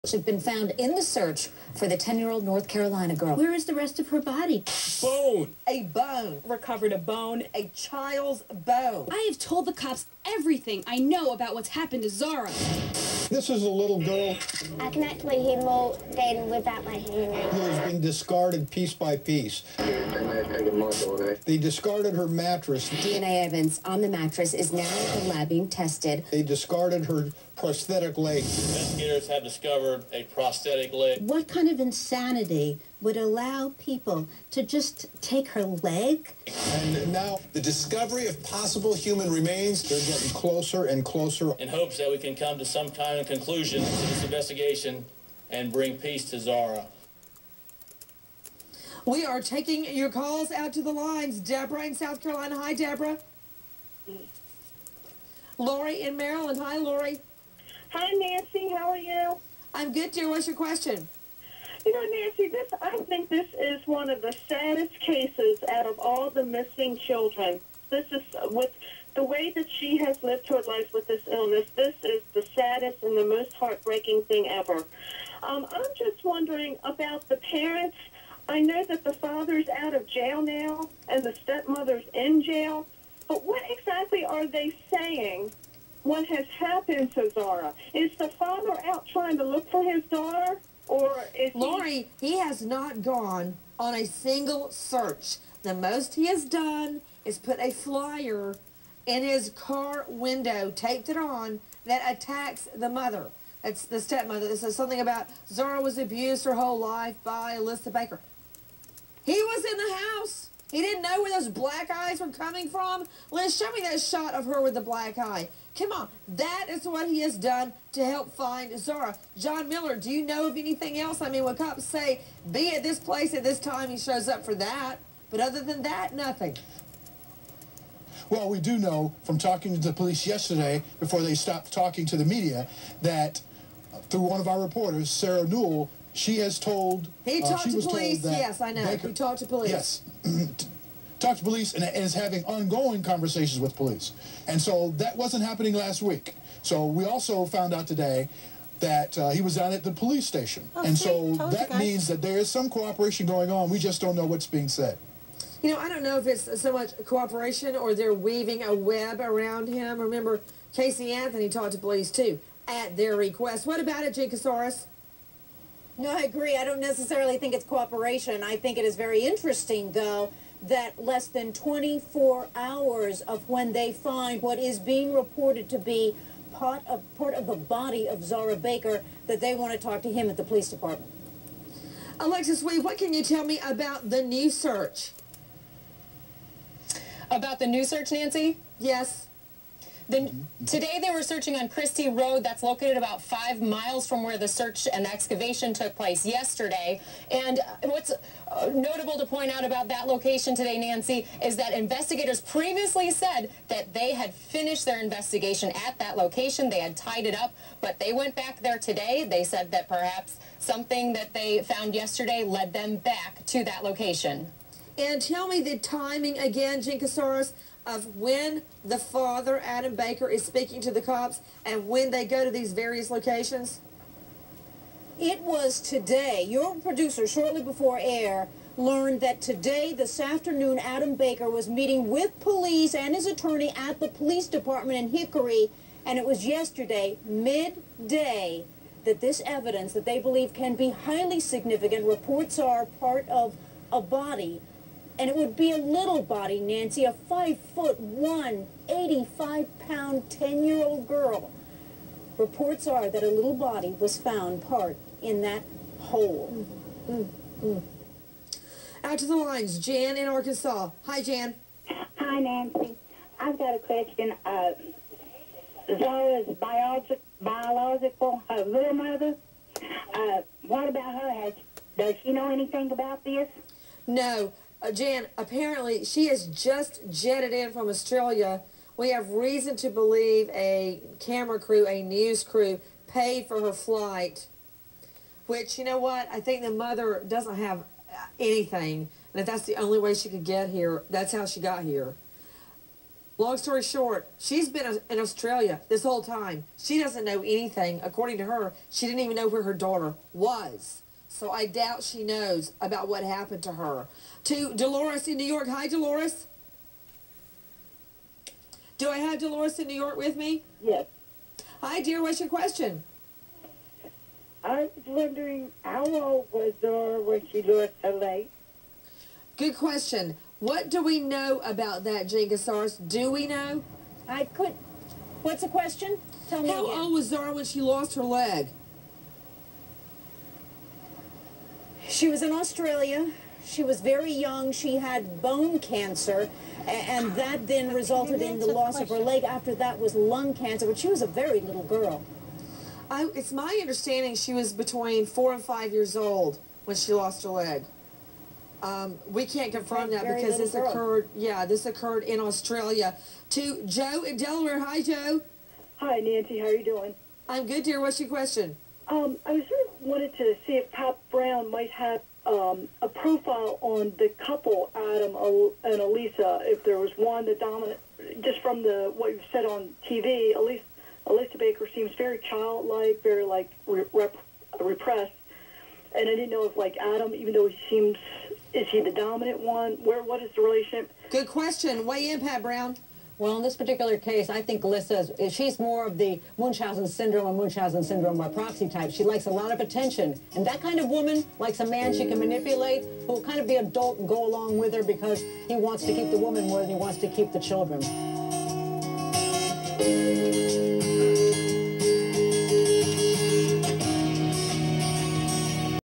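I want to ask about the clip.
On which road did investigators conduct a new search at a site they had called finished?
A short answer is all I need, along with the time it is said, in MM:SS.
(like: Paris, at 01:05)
Christie Road, at 03:11.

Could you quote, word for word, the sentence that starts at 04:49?
And if that's the only way she could get here, that's how she got here.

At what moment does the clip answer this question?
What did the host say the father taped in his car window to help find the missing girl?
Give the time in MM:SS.
01:37.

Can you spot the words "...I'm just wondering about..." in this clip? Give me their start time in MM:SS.
01:15.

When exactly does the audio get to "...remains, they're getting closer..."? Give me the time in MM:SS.
00:39.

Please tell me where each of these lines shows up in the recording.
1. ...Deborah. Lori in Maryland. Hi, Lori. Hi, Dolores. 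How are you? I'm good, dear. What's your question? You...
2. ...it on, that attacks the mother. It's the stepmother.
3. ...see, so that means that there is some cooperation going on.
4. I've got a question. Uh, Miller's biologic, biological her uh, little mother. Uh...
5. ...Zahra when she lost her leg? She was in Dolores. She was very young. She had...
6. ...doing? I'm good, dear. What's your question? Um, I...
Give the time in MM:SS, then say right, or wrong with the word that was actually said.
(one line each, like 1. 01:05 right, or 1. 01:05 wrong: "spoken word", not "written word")
1. 00:52 wrong: "Nancy", not "Dolores"
2. 01:41 right
3. 02:30 right
4. 04:23 wrong: "Zahra", not "Miller"
5. 05:27 wrong: "Australia", not "Dolores"
6. 05:56 right.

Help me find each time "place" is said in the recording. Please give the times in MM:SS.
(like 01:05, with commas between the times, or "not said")
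02:02, 03:15.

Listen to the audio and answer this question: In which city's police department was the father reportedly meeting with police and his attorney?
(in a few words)
Hickory.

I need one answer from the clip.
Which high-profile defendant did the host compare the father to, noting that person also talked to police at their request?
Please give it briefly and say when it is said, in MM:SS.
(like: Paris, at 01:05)
Casey Anthony, at 02:40.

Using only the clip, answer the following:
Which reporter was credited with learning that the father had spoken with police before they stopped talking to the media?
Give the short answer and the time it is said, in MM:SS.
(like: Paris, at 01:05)
Sarah Newell, at 02:15.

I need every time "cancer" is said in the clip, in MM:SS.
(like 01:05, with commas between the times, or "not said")
05:35, 05:40.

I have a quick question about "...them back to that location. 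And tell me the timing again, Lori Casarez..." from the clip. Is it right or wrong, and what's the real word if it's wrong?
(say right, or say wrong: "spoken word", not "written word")
wrong: "Jean", not "Lori".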